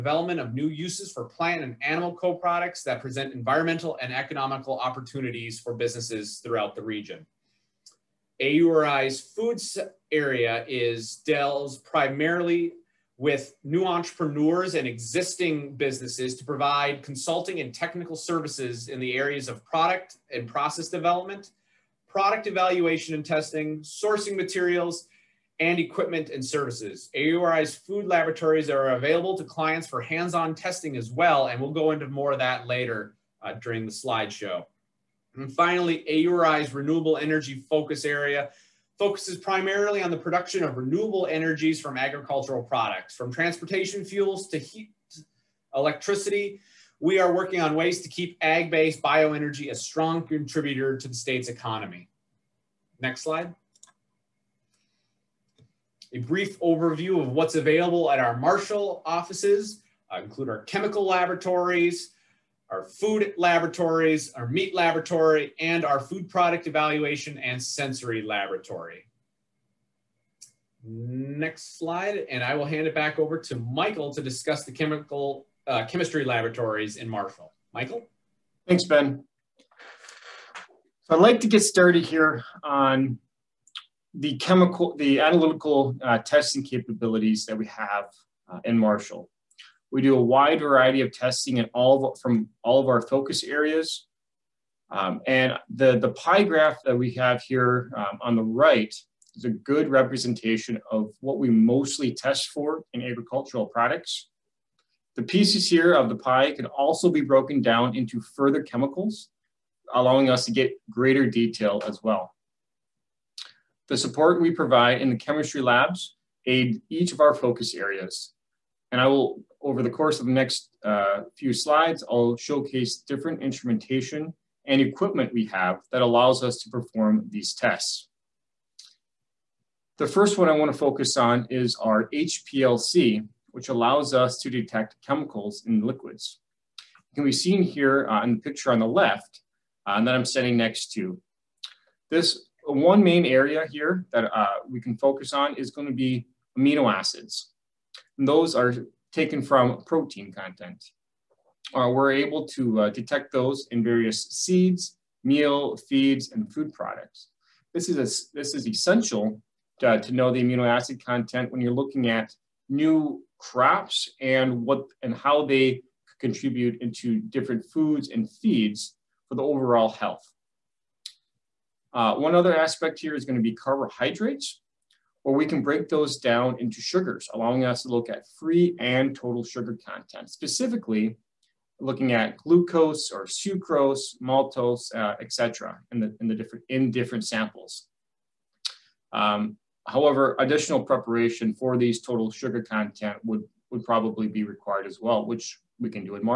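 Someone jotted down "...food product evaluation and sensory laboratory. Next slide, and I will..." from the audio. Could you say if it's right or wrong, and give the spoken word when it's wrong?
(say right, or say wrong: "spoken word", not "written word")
right.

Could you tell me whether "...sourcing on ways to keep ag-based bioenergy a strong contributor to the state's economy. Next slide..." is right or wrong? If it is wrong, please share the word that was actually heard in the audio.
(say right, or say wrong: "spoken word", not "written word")
wrong: "working", not "sourcing".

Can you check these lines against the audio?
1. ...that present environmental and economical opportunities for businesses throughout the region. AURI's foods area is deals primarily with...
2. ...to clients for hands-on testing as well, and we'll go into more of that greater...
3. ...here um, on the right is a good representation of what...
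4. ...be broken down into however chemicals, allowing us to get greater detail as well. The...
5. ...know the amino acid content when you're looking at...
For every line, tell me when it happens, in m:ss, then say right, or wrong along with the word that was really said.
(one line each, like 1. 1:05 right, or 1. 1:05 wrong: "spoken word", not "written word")
1. 0:02 right
2. 0:29 wrong: "later", not "greater"
3. 1:37 right
4. 1:47 wrong: "further", not "however"
5. 2:40 right.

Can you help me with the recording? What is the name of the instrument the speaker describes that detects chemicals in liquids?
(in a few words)
HPLC.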